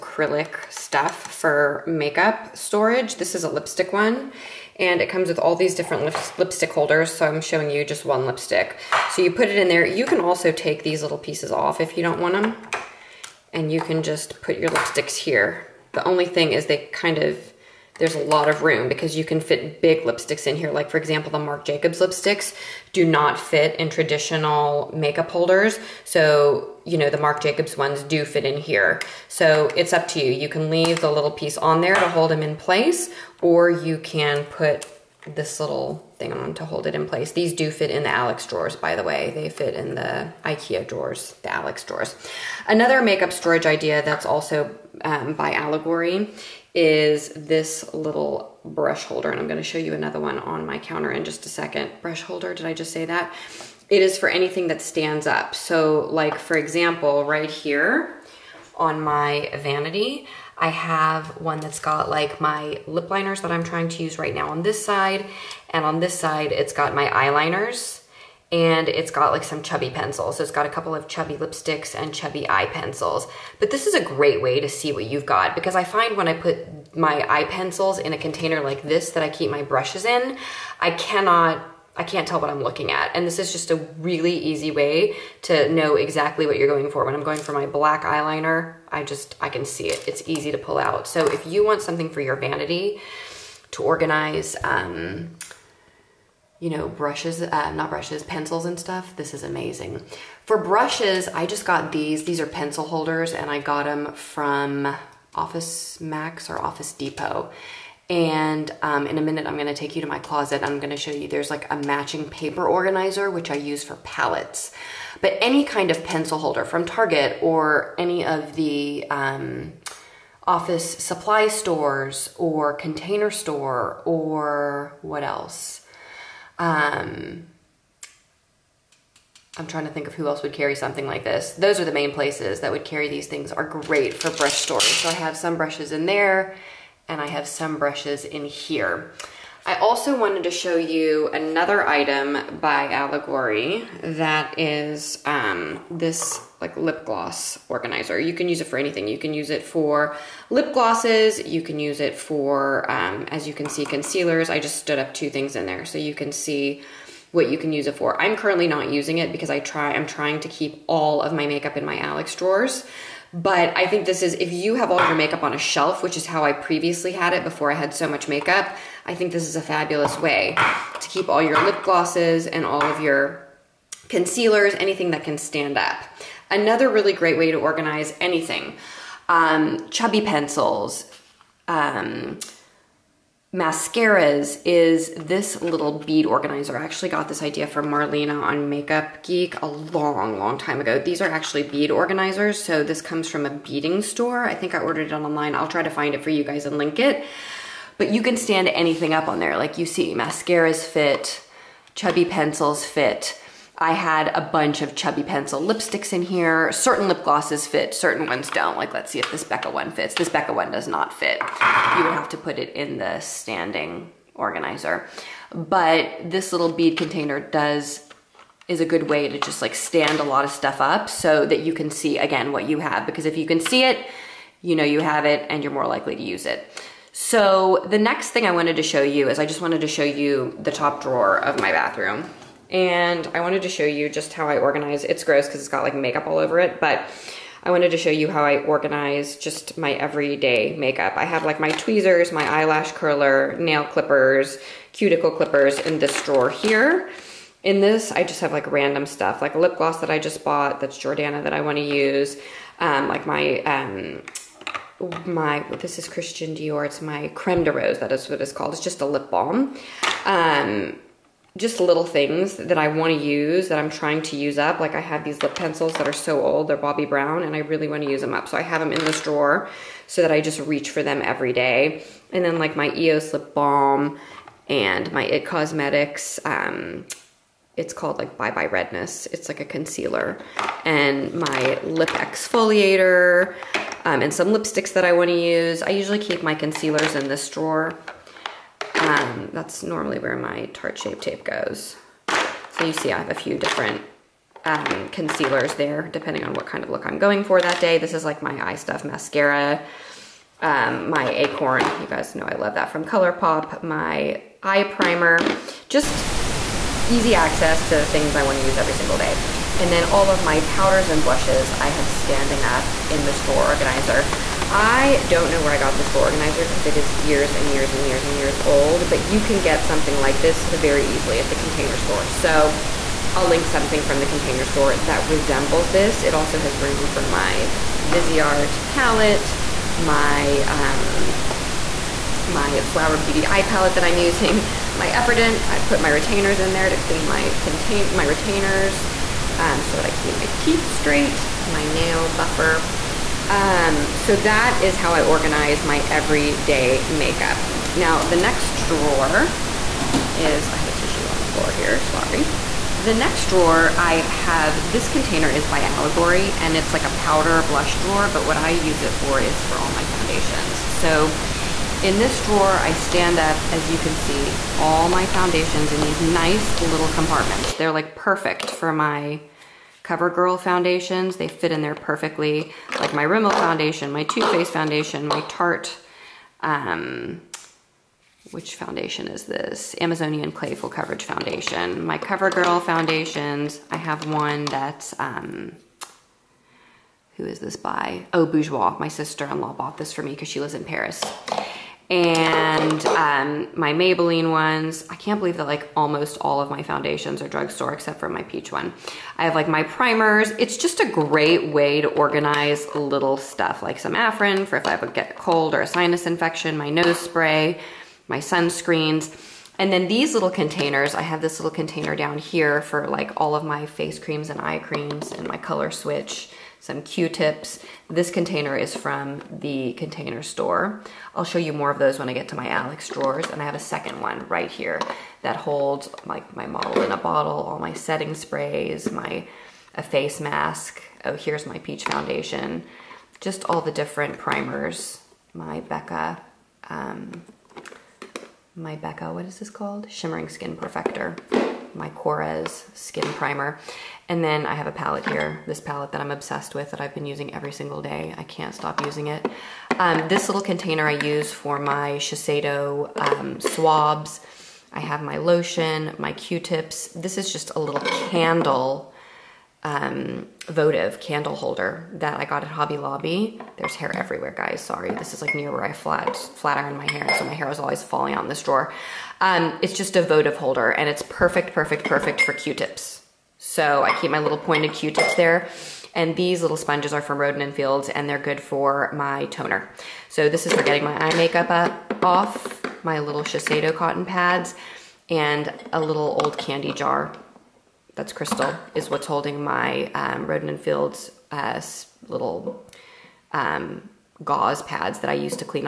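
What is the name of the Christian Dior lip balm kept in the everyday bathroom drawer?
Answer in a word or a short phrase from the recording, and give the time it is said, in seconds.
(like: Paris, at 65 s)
creme de rose, at 257 s.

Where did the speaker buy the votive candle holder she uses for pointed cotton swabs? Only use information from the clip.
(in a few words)
Hobby Lobby.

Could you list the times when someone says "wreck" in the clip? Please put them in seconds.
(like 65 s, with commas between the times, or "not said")
not said.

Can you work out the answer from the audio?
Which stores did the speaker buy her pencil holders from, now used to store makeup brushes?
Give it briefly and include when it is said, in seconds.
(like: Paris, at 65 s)
Office Max or Office Depot, at 105 s.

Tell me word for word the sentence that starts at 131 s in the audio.
Those are the main places that would carry these things are great for brush storage.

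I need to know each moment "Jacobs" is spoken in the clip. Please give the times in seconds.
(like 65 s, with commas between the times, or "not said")
21 s, 27 s.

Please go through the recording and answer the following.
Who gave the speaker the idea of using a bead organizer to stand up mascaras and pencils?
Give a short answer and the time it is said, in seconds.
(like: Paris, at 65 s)
Marlena, at 187 s.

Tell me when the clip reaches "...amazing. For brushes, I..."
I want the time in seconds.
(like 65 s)
99 s.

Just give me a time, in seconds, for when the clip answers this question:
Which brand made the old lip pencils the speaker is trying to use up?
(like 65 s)
266 s.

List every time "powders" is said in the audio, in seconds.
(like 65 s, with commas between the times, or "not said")
310 s, 357 s.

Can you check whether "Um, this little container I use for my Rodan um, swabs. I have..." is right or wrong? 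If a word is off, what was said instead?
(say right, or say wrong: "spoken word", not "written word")
wrong: "Shiseido", not "Rodan".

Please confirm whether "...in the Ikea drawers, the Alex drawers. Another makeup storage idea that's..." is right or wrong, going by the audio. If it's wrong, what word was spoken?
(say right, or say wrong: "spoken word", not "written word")
right.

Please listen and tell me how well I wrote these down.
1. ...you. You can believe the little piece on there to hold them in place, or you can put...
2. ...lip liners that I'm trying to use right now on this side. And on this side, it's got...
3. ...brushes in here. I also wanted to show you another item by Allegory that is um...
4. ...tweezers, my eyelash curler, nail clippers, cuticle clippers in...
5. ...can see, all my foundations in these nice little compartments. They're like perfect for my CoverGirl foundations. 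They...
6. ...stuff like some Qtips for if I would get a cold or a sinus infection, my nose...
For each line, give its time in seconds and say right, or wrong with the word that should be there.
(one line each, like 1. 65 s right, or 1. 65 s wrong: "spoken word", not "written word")
1. 30 s wrong: "leave", not "believe"
2. 62 s right
3. 137 s right
4. 241 s right
5. 363 s right
6. 403 s wrong: "Afrin", not "Qtips".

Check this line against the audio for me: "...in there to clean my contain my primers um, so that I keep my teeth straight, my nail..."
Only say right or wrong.
wrong.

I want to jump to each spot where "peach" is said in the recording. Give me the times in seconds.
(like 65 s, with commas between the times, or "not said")
398 s, 431 s.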